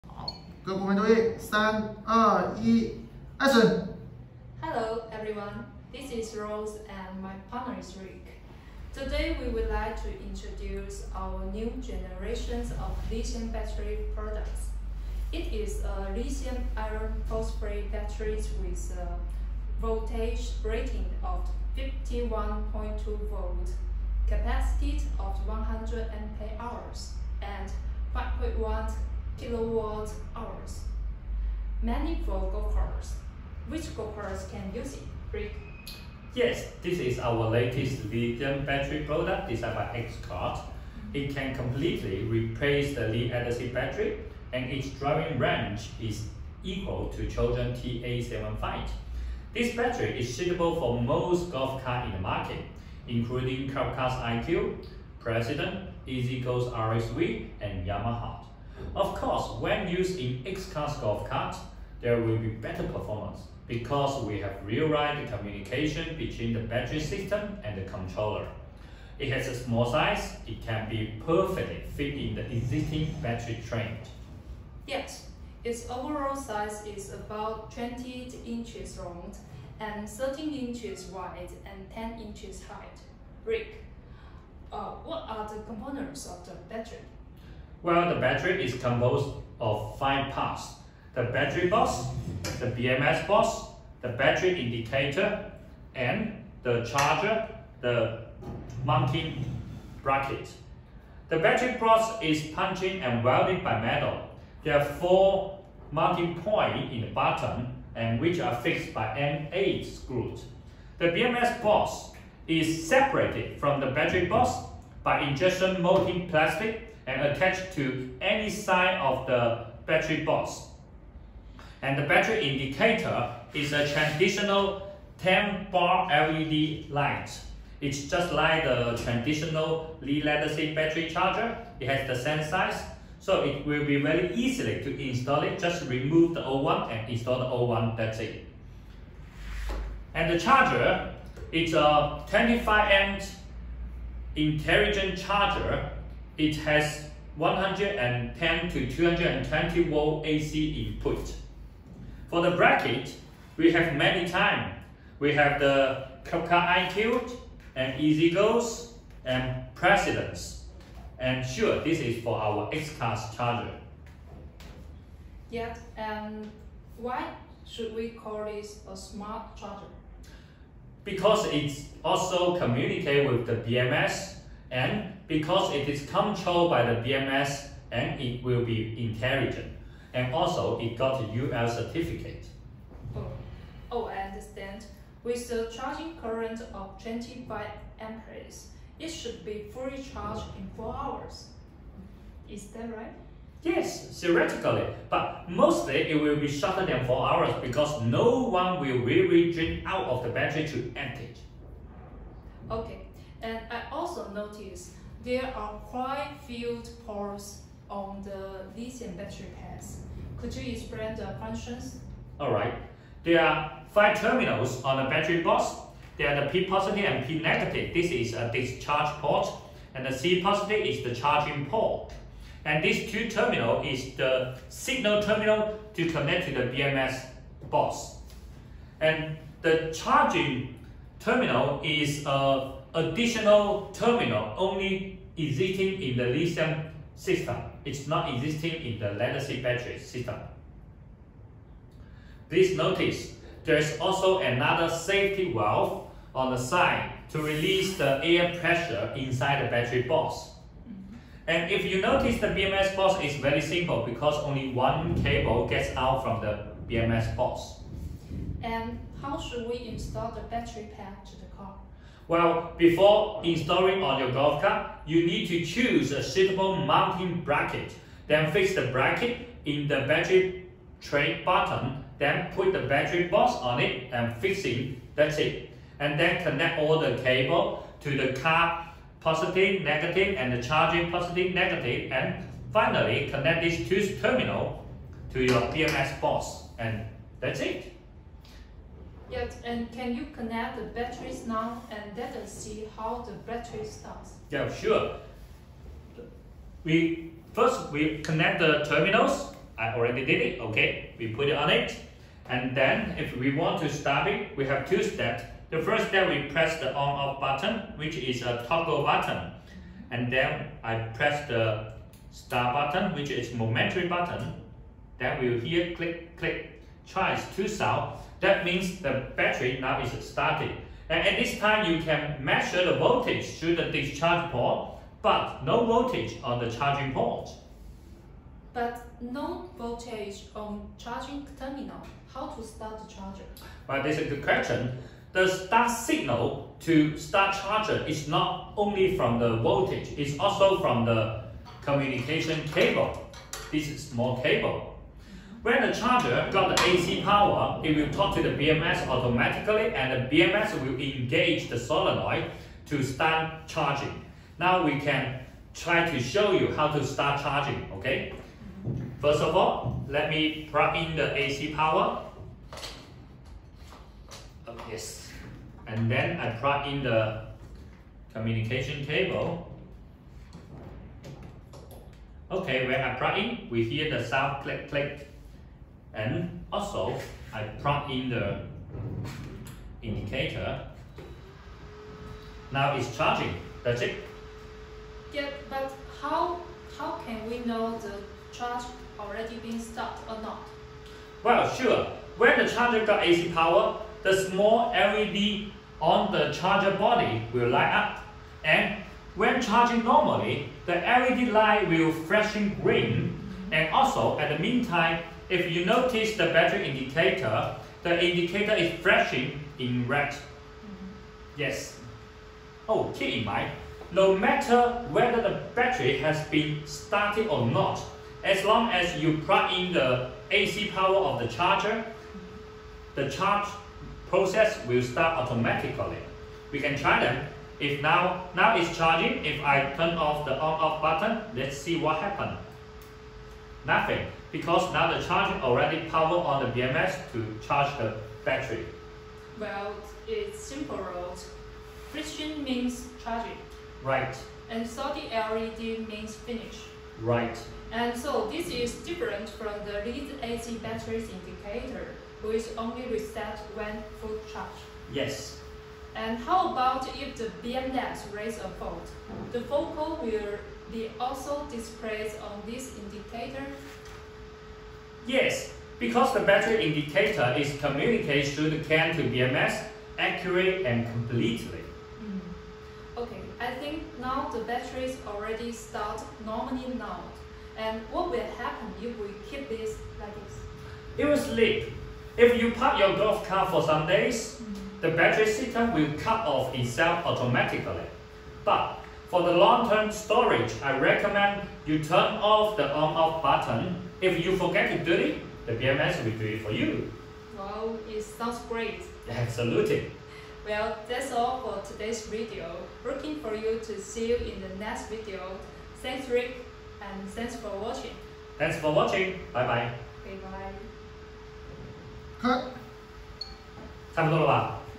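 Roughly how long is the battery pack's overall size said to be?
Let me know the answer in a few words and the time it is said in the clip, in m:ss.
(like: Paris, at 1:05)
20 inches, at 1:17.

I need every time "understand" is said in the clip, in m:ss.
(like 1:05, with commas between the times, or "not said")
3:04.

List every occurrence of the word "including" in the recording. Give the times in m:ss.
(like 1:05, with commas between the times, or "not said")
0:53.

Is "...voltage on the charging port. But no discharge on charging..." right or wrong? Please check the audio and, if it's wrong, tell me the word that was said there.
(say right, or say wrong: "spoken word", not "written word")
wrong: "voltage", not "discharge".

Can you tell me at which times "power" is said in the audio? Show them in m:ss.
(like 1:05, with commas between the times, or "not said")
5:47, 6:01, 6:33, 7:00, 7:16.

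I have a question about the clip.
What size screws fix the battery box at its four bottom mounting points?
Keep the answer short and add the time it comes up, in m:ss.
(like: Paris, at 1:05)
M8, at 1:49.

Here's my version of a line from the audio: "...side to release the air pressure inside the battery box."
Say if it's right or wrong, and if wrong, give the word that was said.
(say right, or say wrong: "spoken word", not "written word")
right.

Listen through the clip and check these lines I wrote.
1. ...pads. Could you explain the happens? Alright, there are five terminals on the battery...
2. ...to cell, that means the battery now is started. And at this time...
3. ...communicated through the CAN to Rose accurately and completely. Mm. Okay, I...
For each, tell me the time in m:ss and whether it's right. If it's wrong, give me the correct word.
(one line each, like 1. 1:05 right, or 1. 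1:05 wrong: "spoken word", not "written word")
1. 3:29 wrong: "functions", not "happens"
2. 5:17 right
3. 7:47 wrong: "BMS", not "Rose".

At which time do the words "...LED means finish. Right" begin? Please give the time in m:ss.
7:25.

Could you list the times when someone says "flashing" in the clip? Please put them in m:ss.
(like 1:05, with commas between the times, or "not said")
6:42, 6:49.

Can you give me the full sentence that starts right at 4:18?
And how should we install the battery pack to the car?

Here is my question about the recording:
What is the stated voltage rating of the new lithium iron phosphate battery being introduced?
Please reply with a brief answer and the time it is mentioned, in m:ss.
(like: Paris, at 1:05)
51.2 volts, at 0:21.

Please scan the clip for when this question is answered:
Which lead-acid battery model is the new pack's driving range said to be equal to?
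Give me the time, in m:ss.
0:47.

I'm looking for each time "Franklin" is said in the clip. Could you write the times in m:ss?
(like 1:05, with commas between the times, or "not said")
not said.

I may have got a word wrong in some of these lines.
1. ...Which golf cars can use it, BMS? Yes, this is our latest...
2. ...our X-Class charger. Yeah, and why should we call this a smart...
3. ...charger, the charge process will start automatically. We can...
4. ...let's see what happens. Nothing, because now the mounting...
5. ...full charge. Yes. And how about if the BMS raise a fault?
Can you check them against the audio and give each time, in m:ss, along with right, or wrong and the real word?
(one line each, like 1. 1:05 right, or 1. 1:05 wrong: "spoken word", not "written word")
1. 0:33 wrong: "Rick", not "BMS"
2. 2:42 right
3. 7:01 right
4. 7:11 wrong: "charging", not "mounting"
5. 7:34 right.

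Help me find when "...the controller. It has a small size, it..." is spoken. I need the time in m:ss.
1:07.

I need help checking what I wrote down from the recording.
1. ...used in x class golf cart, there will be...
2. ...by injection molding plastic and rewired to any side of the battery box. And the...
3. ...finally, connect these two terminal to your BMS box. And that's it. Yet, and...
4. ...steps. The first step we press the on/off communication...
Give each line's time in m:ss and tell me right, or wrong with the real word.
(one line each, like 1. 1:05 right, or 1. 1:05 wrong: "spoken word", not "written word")
1. 0:59 right
2. 1:55 wrong: "attached", not "rewired"
3. 4:42 right
4. 5:05 wrong: "button", not "communication".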